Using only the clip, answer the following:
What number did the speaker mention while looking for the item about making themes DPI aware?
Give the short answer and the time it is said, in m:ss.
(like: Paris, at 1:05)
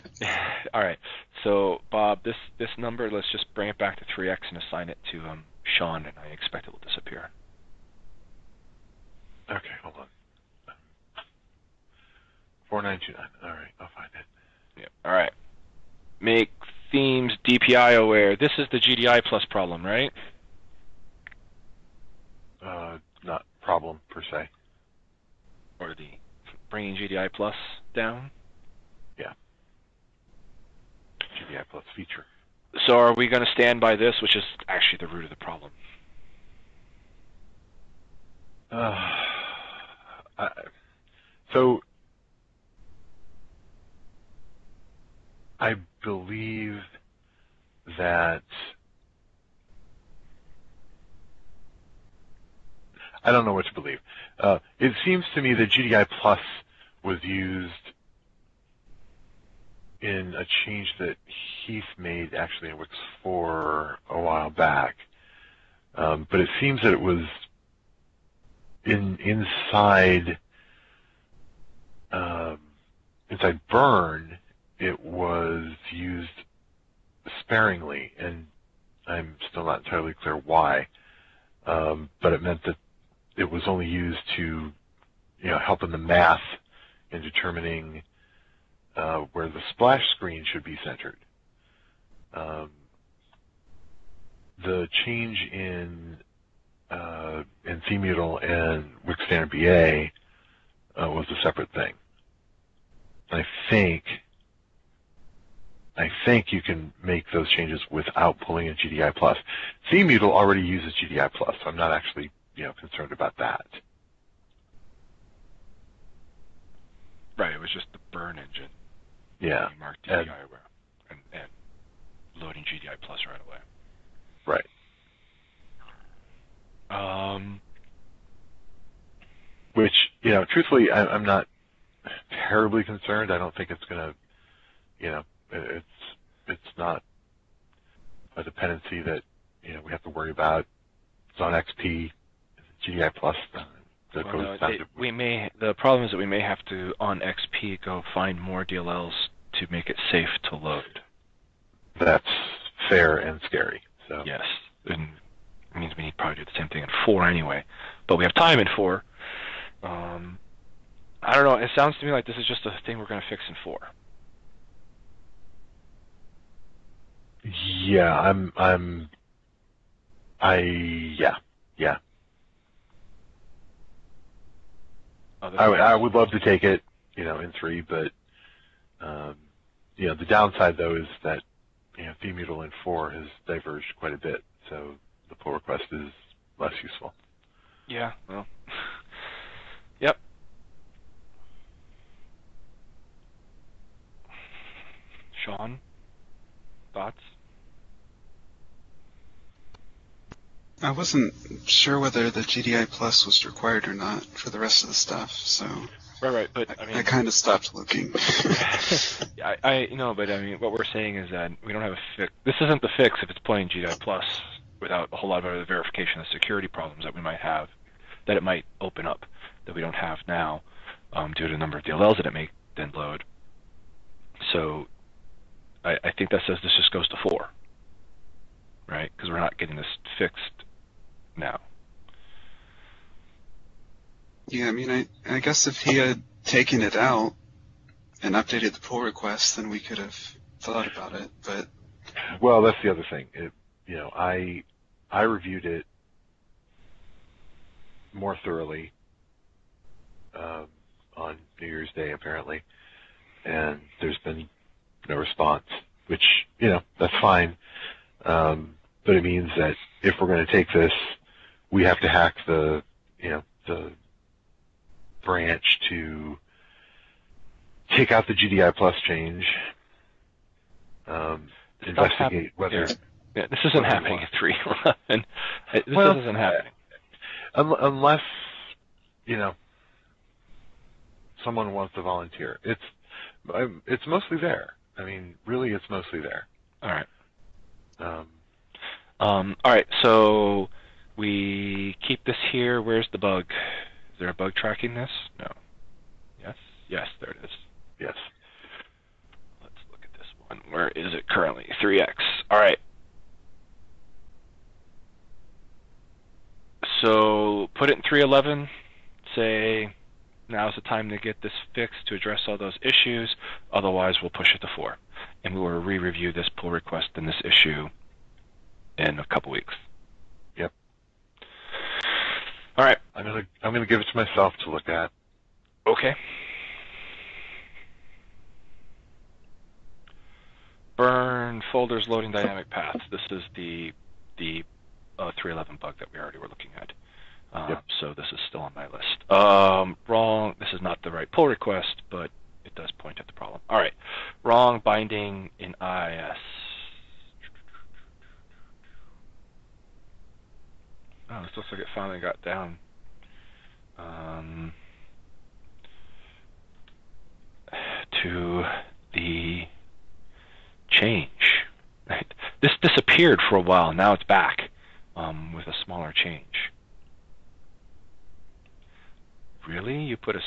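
4929, at 0:12.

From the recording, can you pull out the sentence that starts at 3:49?
Because we're not getting this fixed now.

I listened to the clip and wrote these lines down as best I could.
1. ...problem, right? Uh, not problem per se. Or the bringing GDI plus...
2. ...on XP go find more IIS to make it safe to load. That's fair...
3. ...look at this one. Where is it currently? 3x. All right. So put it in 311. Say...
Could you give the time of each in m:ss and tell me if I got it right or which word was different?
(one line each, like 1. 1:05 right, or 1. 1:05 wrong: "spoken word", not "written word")
1. 0:19 right
2. 2:26 wrong: "DLLs", not "IIS"
3. 4:59 right.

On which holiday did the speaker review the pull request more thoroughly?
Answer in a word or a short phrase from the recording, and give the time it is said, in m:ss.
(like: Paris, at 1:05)
New Year's Day, at 4:11.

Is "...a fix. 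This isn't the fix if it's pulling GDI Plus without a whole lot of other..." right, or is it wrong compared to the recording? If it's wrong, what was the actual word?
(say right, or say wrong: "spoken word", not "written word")
wrong: "playing", not "pulling".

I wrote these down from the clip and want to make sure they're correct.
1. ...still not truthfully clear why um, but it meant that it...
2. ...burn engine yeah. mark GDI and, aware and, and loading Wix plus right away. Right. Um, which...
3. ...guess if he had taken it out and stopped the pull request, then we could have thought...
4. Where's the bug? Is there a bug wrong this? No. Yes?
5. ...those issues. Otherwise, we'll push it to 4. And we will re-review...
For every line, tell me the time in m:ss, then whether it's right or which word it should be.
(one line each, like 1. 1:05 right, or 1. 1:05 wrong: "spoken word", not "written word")
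1. 1:19 wrong: "entirely", not "truthfully"
2. 1:58 wrong: "GDI", not "Wix"
3. 3:55 wrong: "updated", not "stopped"
4. 4:52 wrong: "tracking", not "wrong"
5. 5:12 right.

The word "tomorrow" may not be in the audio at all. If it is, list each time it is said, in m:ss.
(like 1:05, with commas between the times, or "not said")
not said.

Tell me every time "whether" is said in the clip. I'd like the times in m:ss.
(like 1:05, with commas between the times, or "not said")
3:21, 4:32.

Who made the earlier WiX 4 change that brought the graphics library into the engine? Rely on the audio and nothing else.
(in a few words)
Heath.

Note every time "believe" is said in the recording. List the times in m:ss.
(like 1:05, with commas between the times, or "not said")
0:46, 0:53.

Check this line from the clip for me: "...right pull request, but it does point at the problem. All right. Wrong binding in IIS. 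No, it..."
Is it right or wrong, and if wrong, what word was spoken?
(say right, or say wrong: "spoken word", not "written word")
right.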